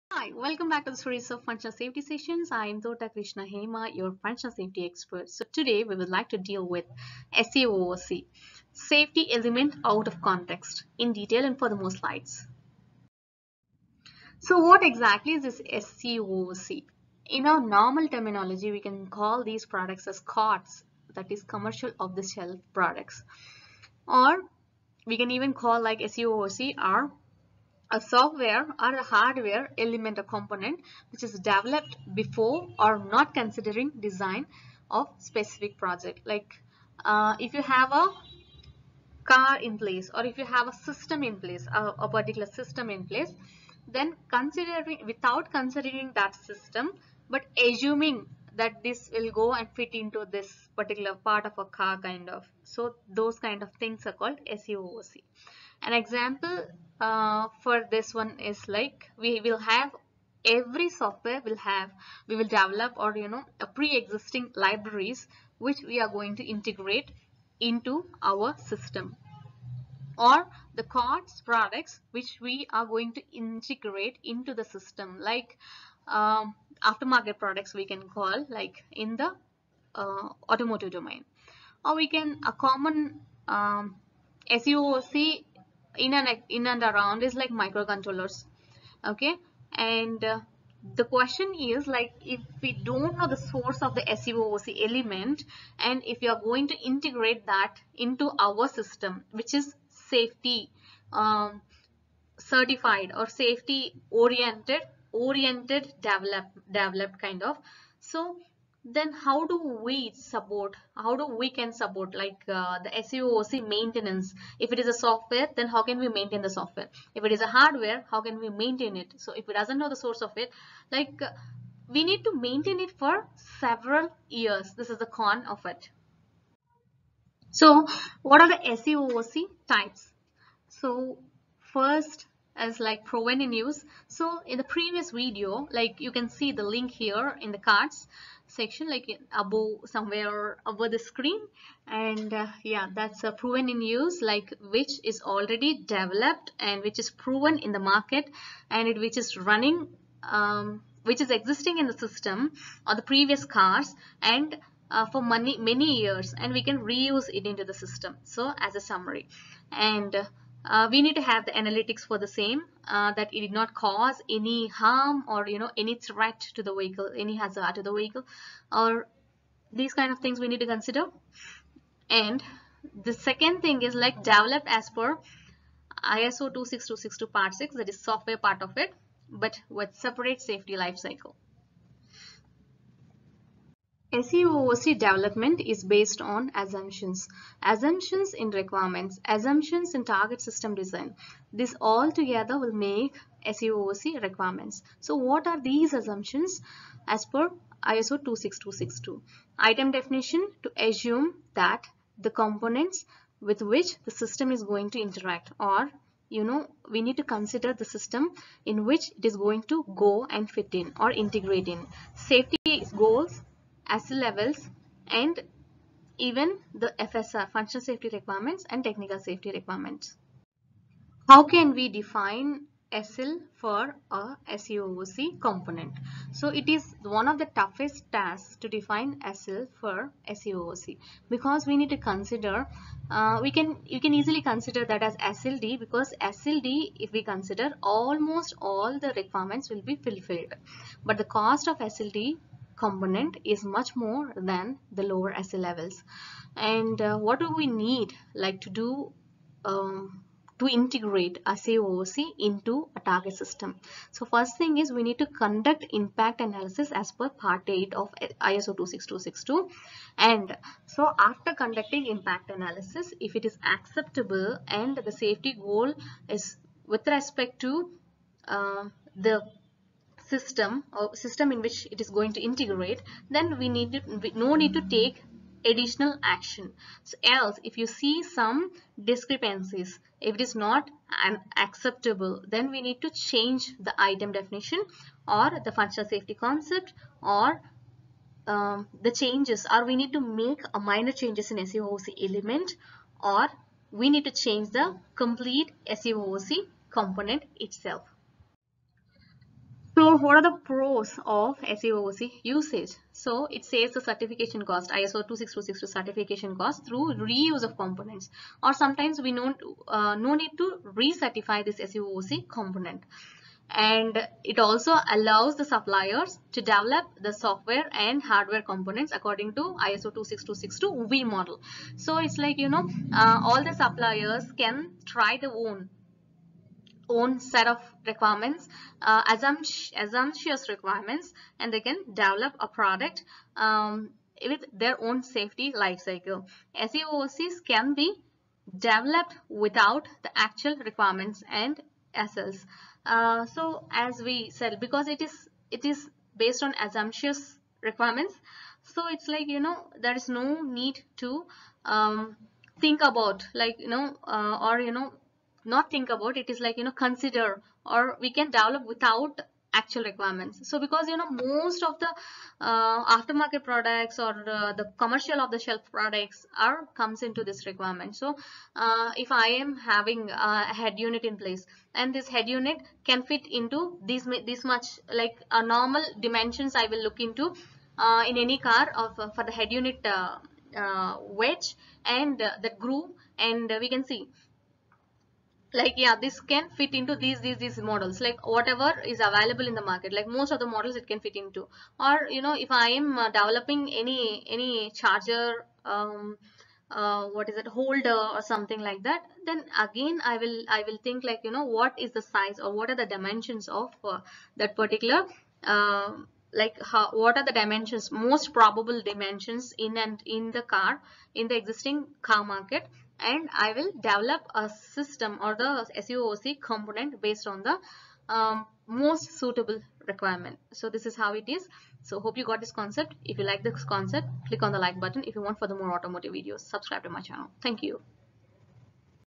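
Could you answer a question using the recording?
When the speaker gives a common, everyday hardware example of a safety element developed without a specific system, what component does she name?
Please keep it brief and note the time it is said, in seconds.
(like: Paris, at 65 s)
Microcontrollers, at 87 s.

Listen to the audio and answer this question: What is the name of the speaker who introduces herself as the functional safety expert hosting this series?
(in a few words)
Thota Krishna Hema.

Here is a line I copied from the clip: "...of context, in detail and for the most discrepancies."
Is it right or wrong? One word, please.
wrong.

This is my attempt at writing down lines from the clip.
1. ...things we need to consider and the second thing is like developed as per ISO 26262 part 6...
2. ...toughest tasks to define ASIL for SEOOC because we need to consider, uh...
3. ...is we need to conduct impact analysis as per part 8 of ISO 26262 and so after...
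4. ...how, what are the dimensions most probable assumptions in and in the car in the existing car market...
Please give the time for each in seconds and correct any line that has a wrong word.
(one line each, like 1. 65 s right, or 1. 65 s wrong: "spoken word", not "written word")
1. 170 s right
2. 227 s right
3. 254 s right
4. 406 s wrong: "dimensions", not "assumptions".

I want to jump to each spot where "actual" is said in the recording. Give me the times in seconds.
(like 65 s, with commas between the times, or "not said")
340 s, 359 s.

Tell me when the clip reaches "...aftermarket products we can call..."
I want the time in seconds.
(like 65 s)
76 s.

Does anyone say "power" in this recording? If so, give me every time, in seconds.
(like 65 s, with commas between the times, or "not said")
not said.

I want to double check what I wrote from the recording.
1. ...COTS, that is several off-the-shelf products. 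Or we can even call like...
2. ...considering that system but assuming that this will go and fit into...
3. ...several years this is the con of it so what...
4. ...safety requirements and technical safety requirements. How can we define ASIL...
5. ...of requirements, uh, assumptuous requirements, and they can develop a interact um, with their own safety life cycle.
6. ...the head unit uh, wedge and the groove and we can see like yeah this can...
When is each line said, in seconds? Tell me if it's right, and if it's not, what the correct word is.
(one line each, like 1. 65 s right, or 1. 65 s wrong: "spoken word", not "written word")
1. 20 s wrong: "commercial", not "several"
2. 45 s right
3. 123 s right
4. 217 s right
5. 327 s wrong: "product", not "interact"
6. 379 s right.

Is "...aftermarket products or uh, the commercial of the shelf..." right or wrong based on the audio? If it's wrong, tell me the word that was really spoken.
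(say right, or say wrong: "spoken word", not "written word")
right.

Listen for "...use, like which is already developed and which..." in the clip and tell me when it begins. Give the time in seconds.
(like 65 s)
143 s.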